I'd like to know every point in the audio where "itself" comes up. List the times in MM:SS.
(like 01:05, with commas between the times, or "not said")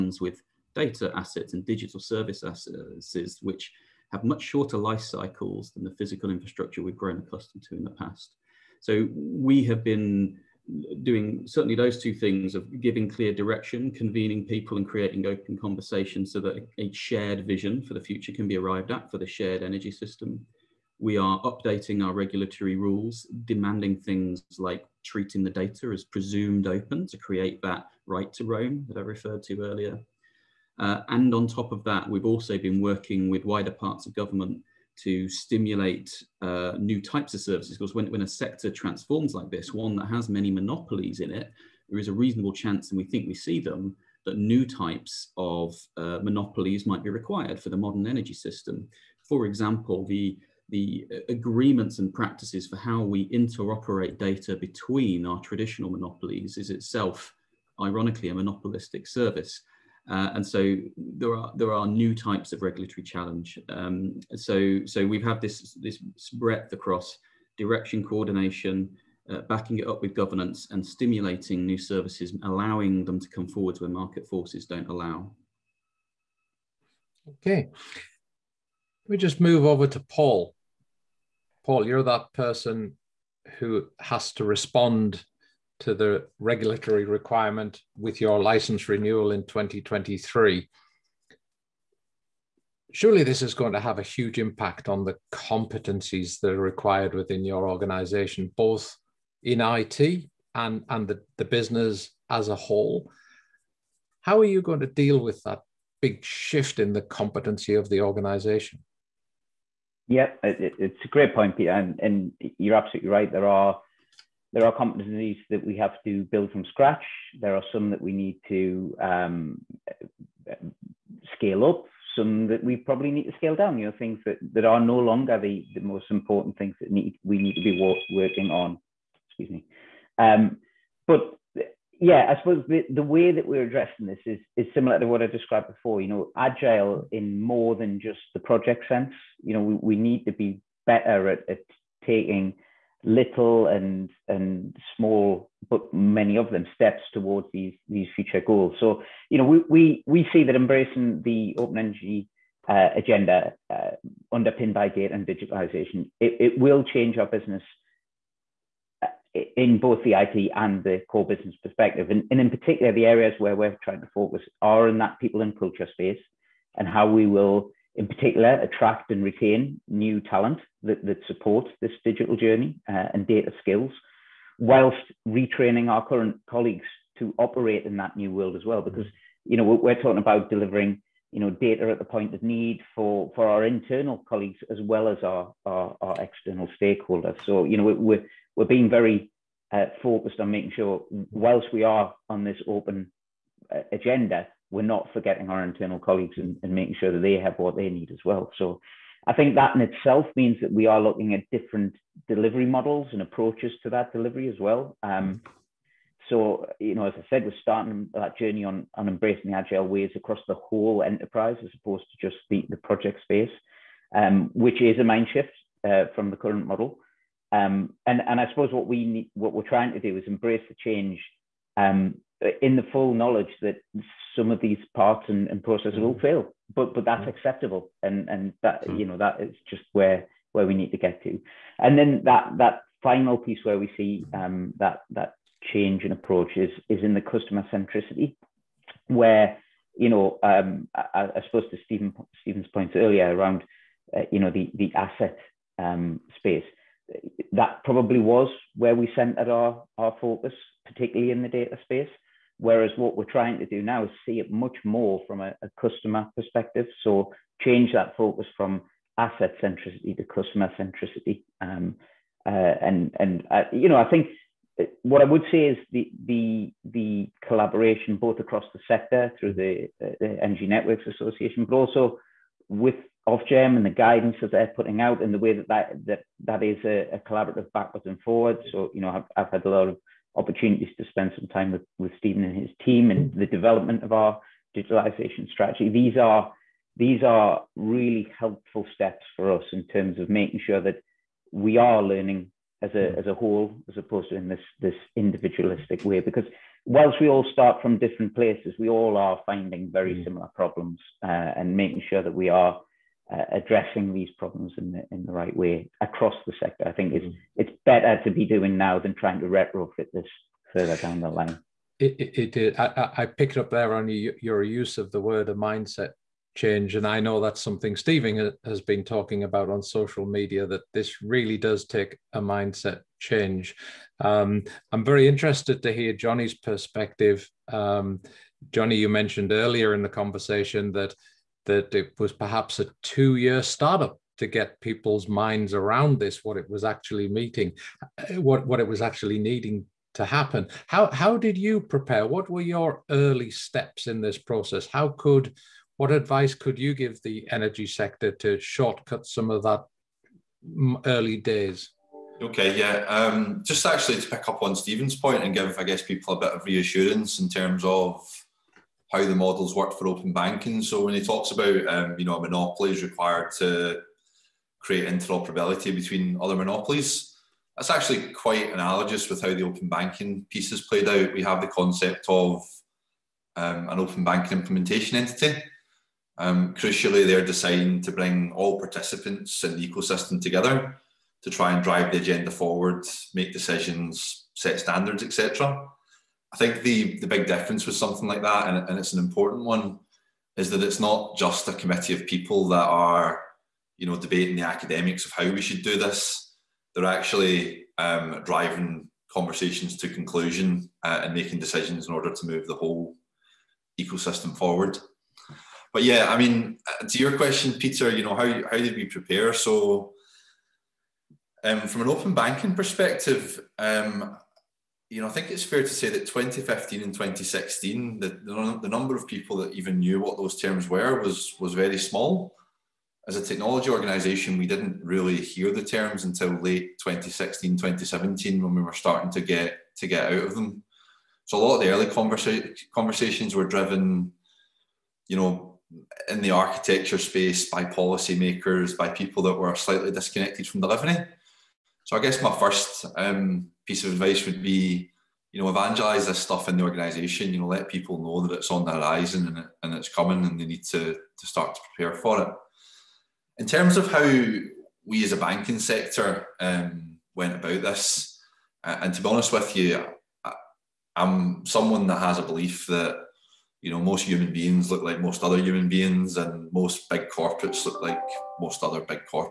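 00:56, 03:19.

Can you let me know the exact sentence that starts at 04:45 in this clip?
These are these are really helpful steps for us in terms of making sure that we are learning as a hmm.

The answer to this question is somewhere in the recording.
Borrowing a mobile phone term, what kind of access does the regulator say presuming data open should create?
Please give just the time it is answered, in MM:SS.
00:28.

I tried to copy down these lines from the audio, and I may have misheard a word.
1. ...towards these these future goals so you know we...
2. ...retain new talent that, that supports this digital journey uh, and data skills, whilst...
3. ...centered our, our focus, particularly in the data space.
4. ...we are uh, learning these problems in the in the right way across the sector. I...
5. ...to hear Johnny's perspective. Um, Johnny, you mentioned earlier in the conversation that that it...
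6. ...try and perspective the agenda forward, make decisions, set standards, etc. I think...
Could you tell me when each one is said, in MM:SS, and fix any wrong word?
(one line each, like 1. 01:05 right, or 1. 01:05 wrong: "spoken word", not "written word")
1. 02:27 right
2. 02:49 right
3. 04:09 right
4. 05:02 wrong: "addressing", not "learning"
5. 05:25 right
6. 06:21 wrong: "drive", not "perspective".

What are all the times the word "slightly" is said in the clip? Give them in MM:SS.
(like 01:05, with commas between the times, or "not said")
07:19.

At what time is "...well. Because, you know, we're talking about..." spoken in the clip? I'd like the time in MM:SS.
02:58.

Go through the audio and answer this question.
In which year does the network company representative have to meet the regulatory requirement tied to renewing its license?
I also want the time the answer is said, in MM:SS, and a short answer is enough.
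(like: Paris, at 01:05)
2023, at 01:29.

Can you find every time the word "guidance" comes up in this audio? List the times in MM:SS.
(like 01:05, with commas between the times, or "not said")
04:33.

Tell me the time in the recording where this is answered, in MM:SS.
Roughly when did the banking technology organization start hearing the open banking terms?
07:06.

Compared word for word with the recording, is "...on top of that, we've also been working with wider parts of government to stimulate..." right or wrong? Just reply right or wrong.
right.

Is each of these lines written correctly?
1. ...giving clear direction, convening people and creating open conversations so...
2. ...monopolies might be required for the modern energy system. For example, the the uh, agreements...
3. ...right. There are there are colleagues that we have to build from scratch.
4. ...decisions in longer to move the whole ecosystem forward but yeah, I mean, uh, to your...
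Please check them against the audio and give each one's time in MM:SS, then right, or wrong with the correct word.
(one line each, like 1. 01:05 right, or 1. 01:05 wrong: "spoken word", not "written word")
1. 00:12 right
2. 00:46 right
3. 01:53 wrong: "competencies", not "colleagues"
4. 06:41 wrong: "order", not "longer".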